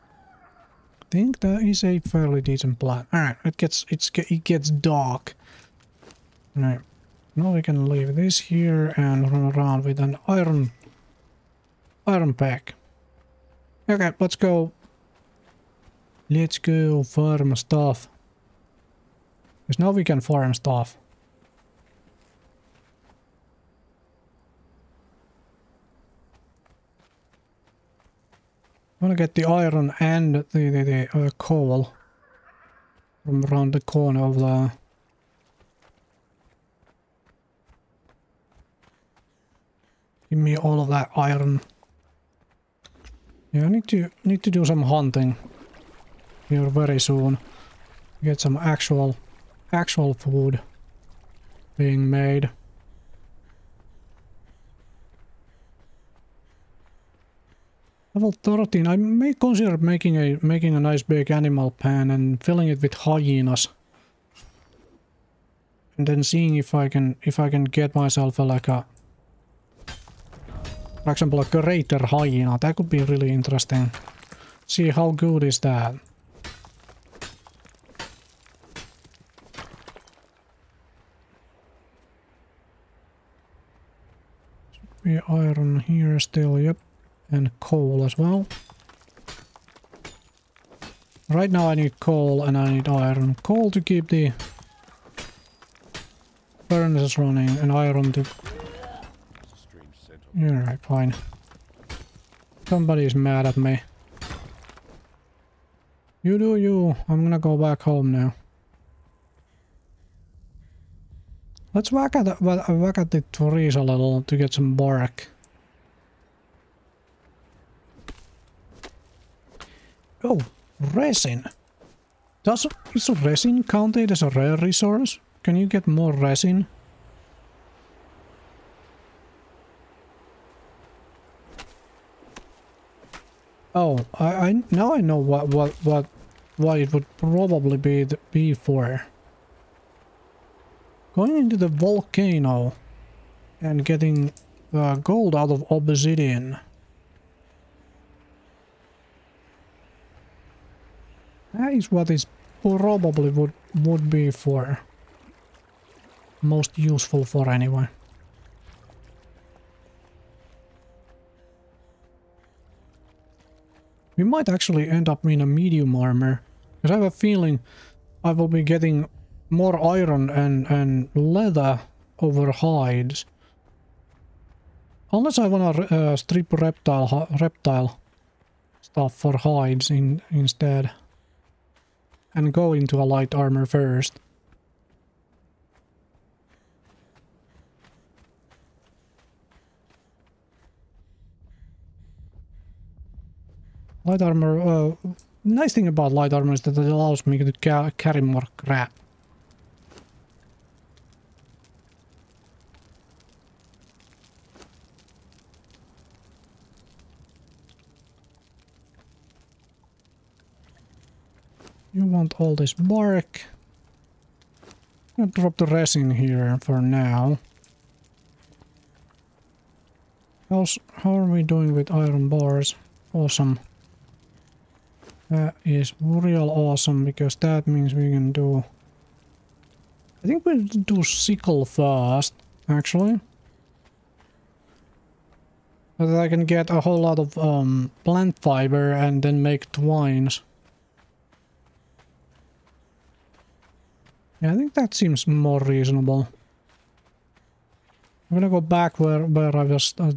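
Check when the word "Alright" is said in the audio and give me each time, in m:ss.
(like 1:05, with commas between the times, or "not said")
1:40.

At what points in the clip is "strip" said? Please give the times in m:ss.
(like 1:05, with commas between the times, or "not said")
2:56.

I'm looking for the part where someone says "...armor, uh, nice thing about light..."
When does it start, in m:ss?
3:14.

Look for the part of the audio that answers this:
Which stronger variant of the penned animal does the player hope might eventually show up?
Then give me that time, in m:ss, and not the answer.
1:11.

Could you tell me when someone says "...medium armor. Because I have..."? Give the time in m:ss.
2:45.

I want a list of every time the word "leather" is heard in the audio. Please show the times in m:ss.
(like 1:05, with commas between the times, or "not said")
2:51.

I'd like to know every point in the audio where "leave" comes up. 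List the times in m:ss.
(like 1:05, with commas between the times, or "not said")
0:07.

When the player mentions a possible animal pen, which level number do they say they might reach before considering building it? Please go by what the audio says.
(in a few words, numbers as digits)
13.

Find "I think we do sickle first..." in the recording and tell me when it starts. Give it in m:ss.
3:50.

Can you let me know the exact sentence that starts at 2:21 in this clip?
Going into the volcano and getting uh, gold out of obsidian.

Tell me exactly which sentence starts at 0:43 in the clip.
Yeah, I need to need to do some hunting here very soon.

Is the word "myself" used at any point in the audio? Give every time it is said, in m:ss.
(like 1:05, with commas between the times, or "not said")
1:07.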